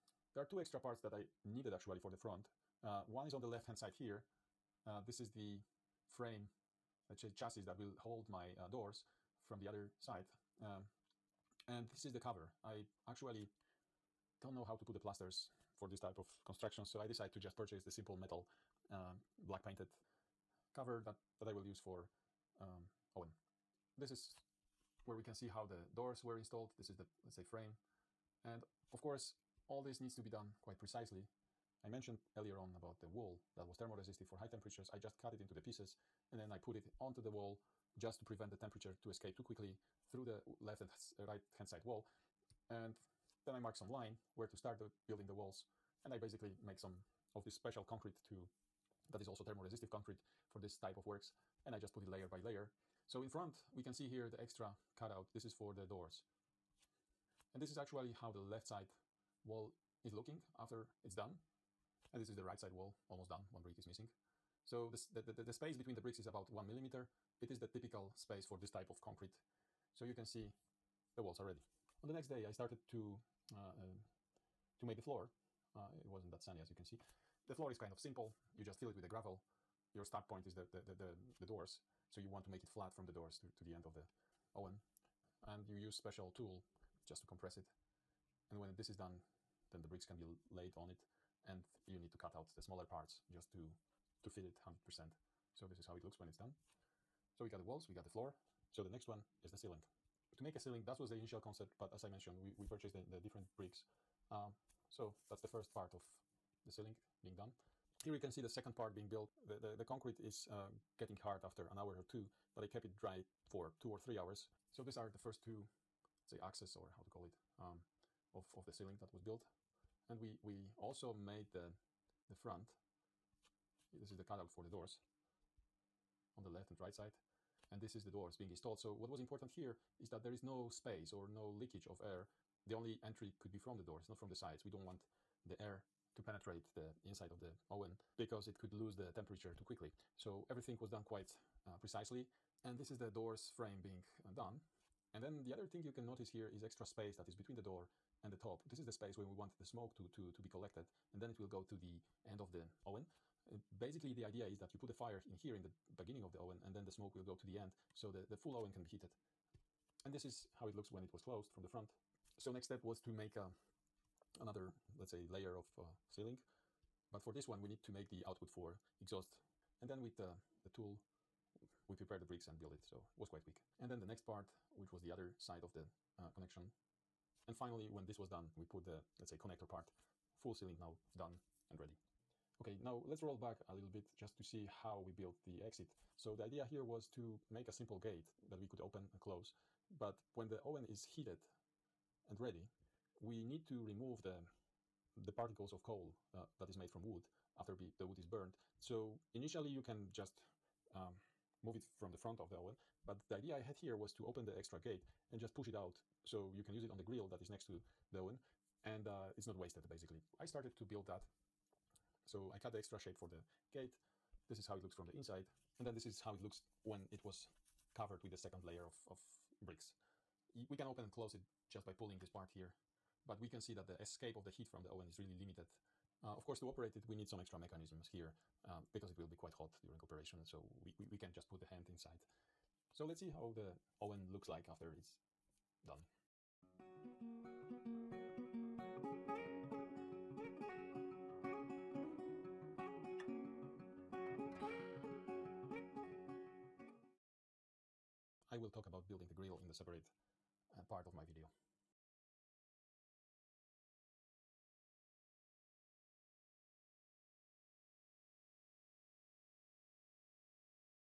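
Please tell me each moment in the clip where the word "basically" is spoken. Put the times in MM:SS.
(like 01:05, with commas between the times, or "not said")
00:46, 02:33, 03:29.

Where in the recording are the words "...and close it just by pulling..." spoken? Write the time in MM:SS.
03:41.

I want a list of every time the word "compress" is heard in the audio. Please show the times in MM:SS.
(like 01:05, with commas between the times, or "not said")
01:27.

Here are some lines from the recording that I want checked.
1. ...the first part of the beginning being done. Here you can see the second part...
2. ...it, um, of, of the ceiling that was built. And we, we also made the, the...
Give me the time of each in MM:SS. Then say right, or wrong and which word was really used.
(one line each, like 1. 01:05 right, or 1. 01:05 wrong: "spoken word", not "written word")
1. 01:45 wrong: "ceiling", not "beginning"
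2. 01:57 right.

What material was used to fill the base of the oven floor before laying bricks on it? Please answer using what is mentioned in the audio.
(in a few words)
Gravel.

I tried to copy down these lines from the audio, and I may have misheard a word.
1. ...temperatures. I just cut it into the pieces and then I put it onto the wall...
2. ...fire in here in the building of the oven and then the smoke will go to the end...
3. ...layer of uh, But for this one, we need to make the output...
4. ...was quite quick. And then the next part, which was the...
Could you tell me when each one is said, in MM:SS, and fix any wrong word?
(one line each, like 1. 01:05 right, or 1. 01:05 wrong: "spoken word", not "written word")
1. 00:34 right
2. 02:34 wrong: "beginning", not "building"
3. 02:45 right
4. 02:53 right.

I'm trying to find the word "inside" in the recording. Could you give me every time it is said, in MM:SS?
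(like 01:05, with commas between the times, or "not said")
02:17, 03:35, 03:51.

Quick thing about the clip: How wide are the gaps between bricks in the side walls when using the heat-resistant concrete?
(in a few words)
1 millimeter.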